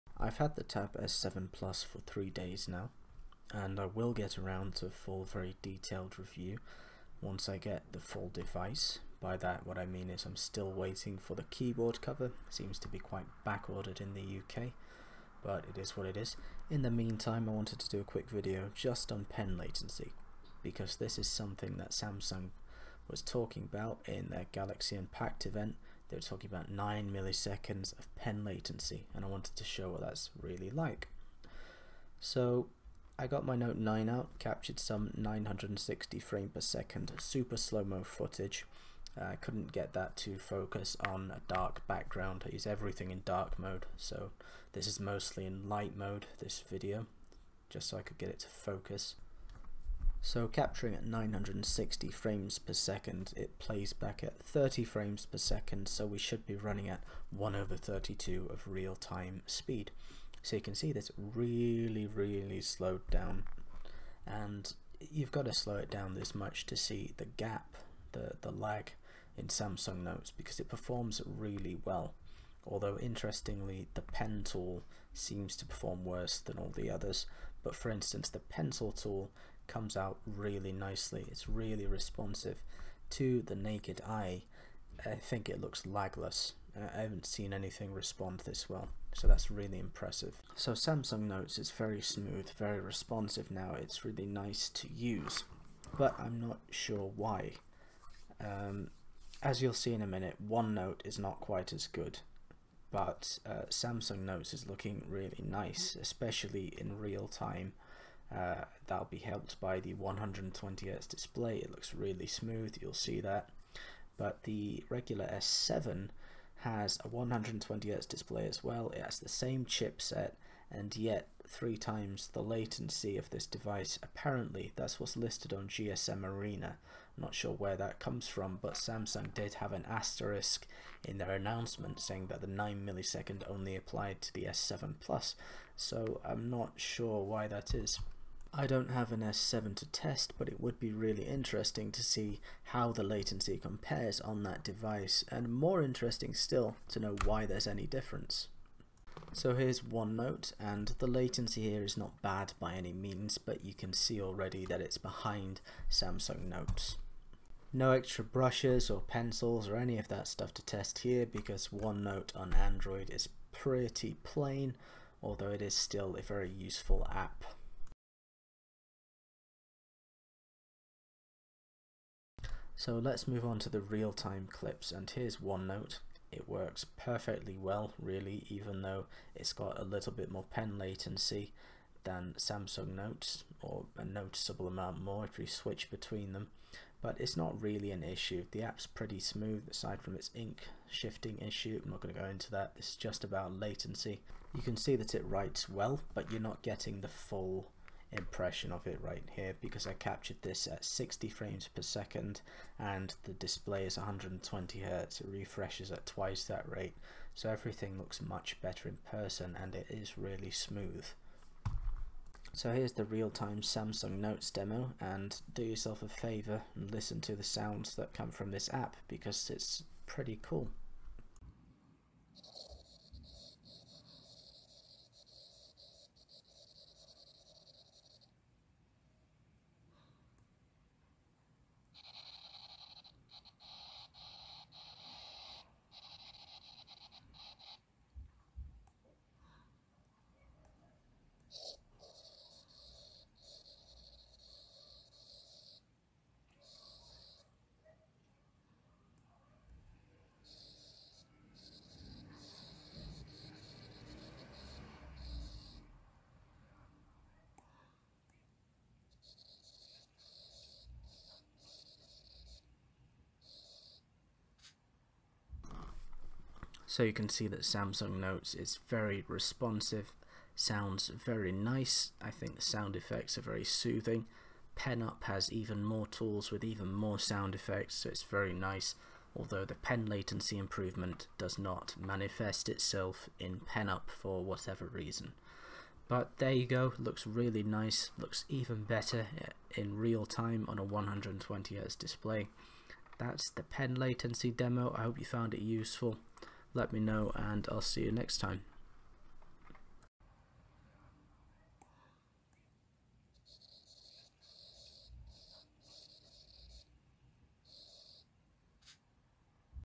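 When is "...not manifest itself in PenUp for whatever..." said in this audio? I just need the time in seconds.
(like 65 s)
281 s.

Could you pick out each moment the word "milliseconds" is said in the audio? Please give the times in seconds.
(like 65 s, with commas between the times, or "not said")
27 s, 132 s.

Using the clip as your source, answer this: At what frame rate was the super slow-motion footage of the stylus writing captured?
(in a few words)
960 frames per second.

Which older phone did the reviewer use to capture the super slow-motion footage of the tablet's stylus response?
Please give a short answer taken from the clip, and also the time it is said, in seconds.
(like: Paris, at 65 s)
Note 9, at 33 s.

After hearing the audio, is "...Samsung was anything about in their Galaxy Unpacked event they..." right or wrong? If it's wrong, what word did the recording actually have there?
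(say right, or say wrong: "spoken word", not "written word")
wrong: "talking", not "anything".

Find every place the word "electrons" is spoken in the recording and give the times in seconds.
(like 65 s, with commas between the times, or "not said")
not said.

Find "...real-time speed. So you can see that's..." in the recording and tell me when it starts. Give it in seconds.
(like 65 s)
58 s.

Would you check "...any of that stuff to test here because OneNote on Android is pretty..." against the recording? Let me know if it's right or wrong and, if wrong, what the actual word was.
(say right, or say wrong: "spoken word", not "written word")
right.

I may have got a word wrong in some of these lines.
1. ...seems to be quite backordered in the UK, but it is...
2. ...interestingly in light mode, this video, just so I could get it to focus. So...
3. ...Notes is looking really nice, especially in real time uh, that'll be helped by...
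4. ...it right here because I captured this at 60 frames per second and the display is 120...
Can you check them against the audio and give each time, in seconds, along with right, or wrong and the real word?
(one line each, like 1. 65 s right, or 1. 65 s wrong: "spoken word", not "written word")
1. 12 s right
2. 45 s wrong: "mostly", not "interestingly"
3. 104 s right
4. 198 s right.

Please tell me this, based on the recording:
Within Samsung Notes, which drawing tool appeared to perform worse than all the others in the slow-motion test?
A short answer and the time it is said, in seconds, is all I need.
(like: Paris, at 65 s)
pen tool, at 73 s.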